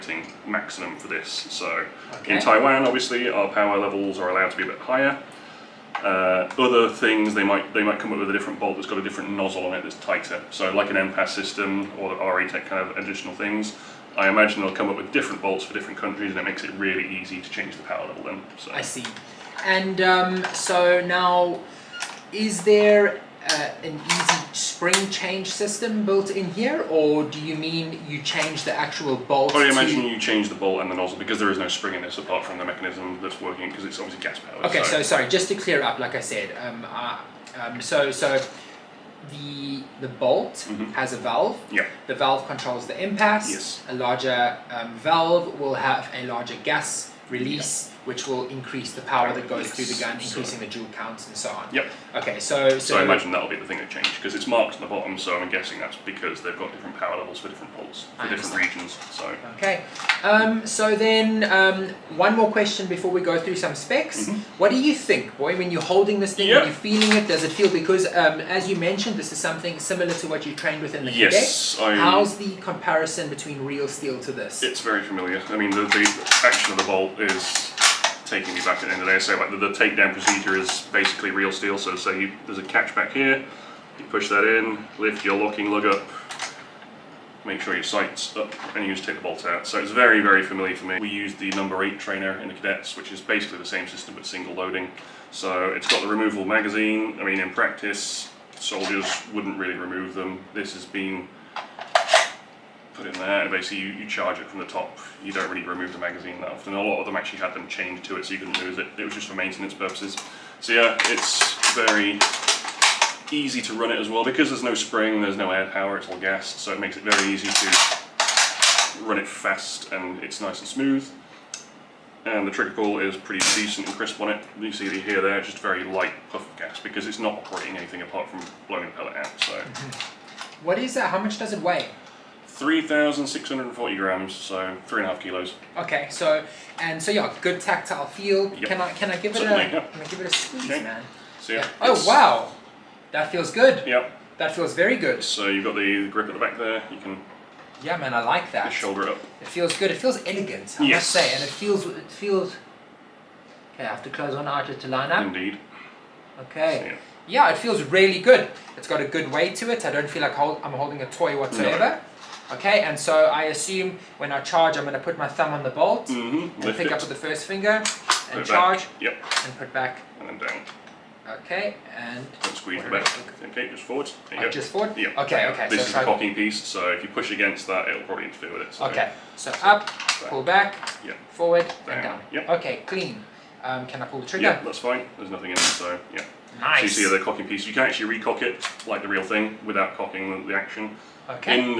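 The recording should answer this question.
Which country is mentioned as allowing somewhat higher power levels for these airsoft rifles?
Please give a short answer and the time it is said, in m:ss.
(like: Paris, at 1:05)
Taiwan, at 0:02.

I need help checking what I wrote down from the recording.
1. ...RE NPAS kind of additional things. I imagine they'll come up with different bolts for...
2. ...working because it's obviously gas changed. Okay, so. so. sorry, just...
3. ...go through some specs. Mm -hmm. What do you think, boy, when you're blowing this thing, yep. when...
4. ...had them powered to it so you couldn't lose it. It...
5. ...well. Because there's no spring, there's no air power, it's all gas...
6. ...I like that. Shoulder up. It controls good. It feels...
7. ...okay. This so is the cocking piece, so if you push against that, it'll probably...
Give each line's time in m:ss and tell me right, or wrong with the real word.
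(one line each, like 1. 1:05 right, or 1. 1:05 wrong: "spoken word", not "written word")
1. 0:12 wrong: "Tech", not "NPAS"
2. 0:33 wrong: "powered", not "changed"
3. 1:03 wrong: "holding", not "blowing"
4. 1:47 wrong: "chained", not "powered"
5. 1:54 right
6. 2:28 wrong: "feels", not "controls"
7. 2:55 right.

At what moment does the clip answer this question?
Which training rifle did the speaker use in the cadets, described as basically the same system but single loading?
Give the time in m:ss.
1:31.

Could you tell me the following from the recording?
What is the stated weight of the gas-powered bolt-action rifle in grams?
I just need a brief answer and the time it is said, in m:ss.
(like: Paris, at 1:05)
3,640 grams, at 2:12.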